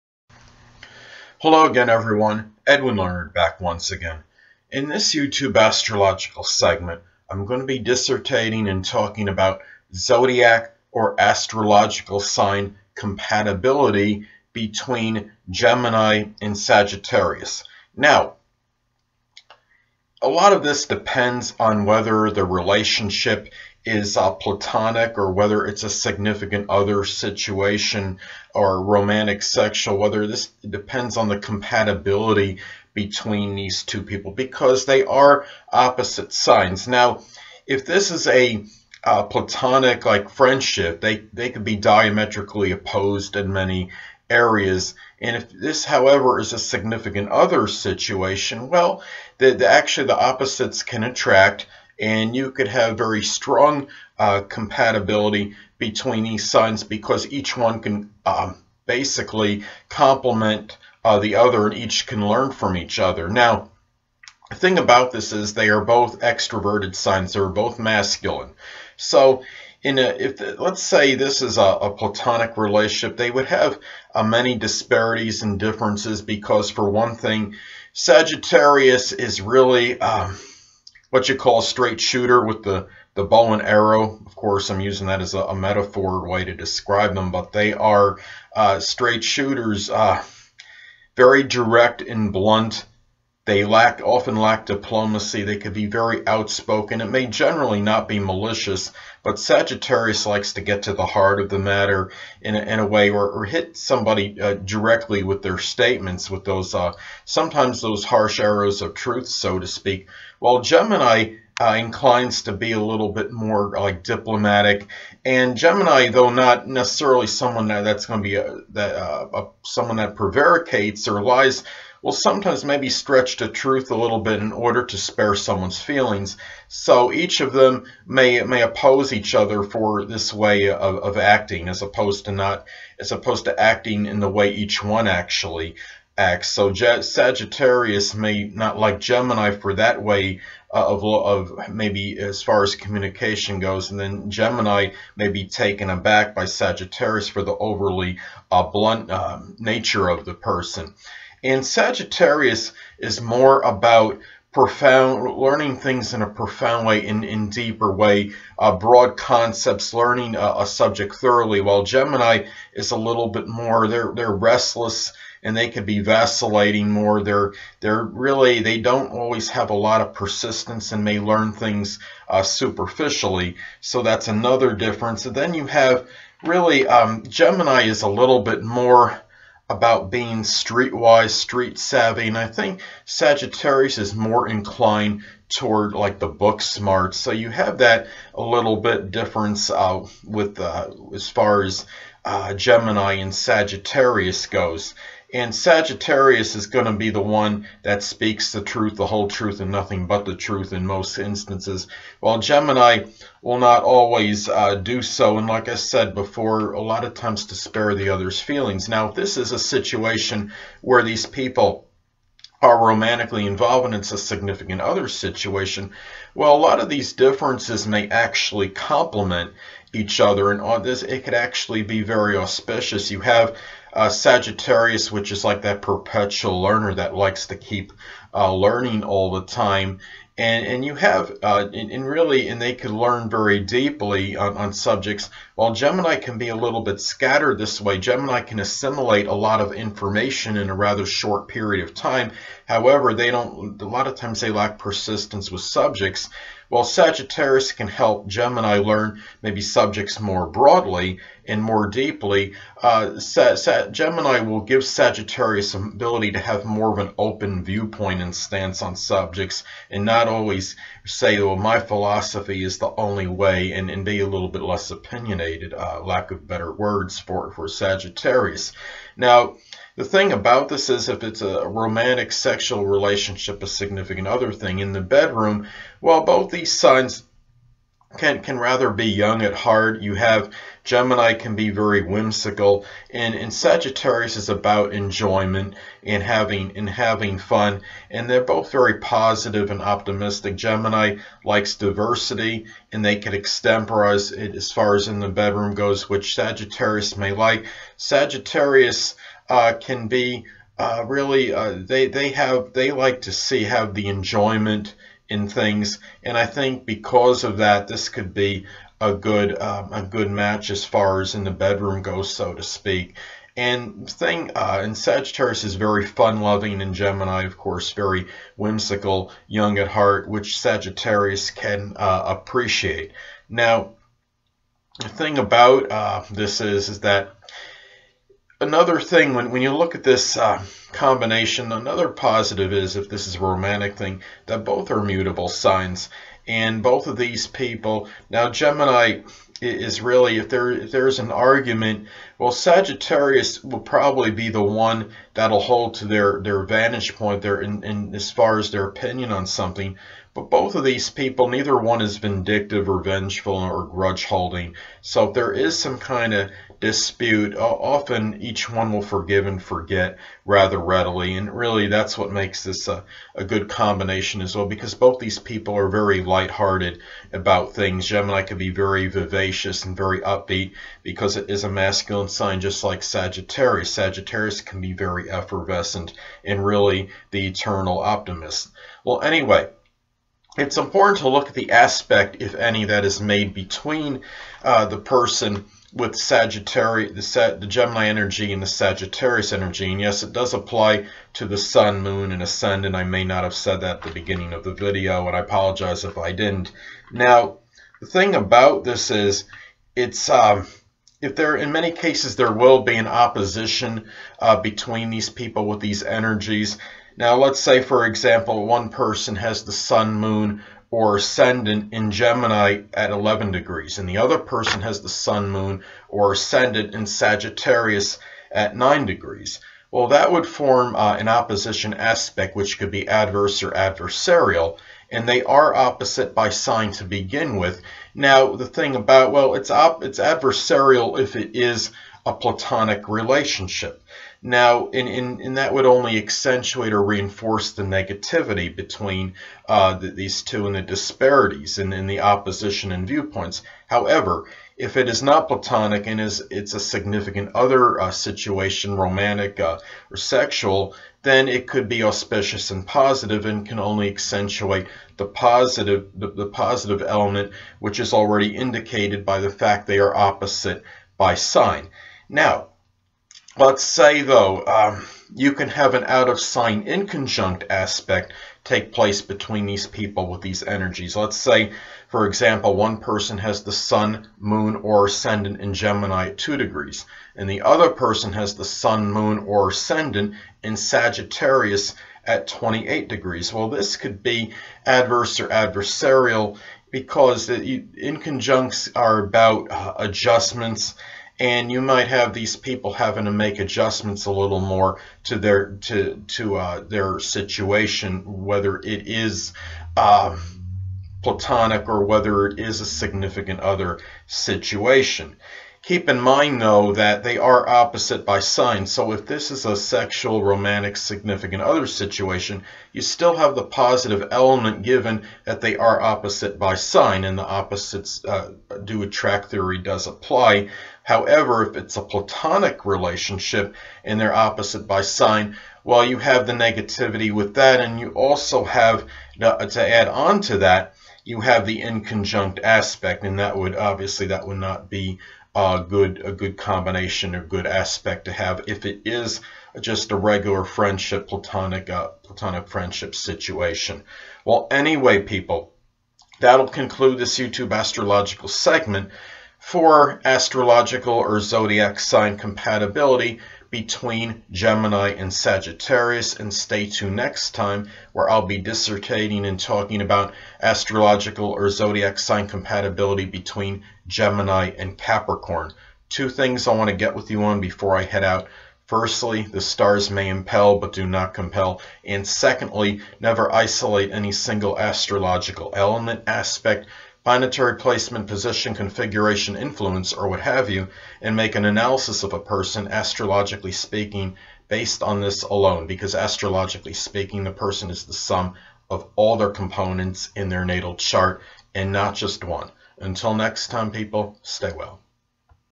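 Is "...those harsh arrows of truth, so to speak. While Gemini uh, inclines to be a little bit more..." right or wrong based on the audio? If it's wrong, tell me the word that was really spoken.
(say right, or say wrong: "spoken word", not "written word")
right.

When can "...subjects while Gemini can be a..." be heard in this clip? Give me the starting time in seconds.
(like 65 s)
234 s.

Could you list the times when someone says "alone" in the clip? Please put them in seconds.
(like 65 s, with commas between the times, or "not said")
585 s.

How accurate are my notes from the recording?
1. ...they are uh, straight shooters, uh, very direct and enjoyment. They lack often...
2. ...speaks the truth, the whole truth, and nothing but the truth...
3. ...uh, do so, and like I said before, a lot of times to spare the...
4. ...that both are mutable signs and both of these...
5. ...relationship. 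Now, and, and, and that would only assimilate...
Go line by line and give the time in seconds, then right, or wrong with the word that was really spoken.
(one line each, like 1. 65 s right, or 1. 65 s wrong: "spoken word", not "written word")
1. 87 s wrong: "blunt", not "enjoyment"
2. 198 s right
3. 204 s right
4. 334 s right
5. 433 s wrong: "accentuate", not "assimilate".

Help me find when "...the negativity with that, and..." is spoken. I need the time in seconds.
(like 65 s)
526 s.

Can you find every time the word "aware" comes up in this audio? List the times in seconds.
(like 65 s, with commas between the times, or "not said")
not said.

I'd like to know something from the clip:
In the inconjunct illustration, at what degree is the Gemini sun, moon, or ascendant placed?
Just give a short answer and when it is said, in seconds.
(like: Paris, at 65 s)
2, at 476 s.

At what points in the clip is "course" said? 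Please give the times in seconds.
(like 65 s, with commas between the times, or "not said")
84 s, 317 s.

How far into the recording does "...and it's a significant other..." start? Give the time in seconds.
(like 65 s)
213 s.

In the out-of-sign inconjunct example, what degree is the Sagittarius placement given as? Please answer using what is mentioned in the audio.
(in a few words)
28.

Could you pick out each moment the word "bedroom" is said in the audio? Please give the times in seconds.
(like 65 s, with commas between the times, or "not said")
275 s, 295 s, 311 s.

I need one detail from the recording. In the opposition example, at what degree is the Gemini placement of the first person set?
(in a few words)
11.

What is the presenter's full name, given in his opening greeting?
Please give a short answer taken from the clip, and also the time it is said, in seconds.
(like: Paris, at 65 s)
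Edwin Learnard, at 2 s.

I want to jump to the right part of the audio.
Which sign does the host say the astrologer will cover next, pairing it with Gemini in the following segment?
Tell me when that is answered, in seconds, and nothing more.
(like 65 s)
564 s.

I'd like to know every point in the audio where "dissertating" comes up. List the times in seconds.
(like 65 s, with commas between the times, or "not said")
7 s, 558 s.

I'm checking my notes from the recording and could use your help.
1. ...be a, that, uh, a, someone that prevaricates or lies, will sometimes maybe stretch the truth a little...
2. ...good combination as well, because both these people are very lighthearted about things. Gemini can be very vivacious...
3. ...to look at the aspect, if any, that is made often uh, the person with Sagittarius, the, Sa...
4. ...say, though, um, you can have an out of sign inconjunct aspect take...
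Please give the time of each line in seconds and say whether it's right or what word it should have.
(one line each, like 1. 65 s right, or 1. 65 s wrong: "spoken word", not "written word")
1. 118 s right
2. 363 s right
3. 381 s wrong: "between", not "often"
4. 463 s right.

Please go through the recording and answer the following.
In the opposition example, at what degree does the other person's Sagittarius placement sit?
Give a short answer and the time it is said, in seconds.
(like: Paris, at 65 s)
9, at 418 s.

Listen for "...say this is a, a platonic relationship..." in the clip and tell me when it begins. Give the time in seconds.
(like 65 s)
70 s.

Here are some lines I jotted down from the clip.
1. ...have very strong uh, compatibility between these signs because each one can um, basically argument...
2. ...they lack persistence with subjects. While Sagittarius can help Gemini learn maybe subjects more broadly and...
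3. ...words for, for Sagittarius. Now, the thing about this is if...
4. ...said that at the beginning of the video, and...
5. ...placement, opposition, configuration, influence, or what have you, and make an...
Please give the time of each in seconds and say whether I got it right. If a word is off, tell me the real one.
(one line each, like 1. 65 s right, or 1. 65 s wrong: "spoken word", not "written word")
1. 52 s wrong: "complement", not "argument"
2. 244 s right
3. 266 s right
4. 393 s right
5. 577 s wrong: "position", not "opposition".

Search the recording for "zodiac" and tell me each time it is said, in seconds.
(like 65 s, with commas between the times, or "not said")
9 s, 551 s, 561 s.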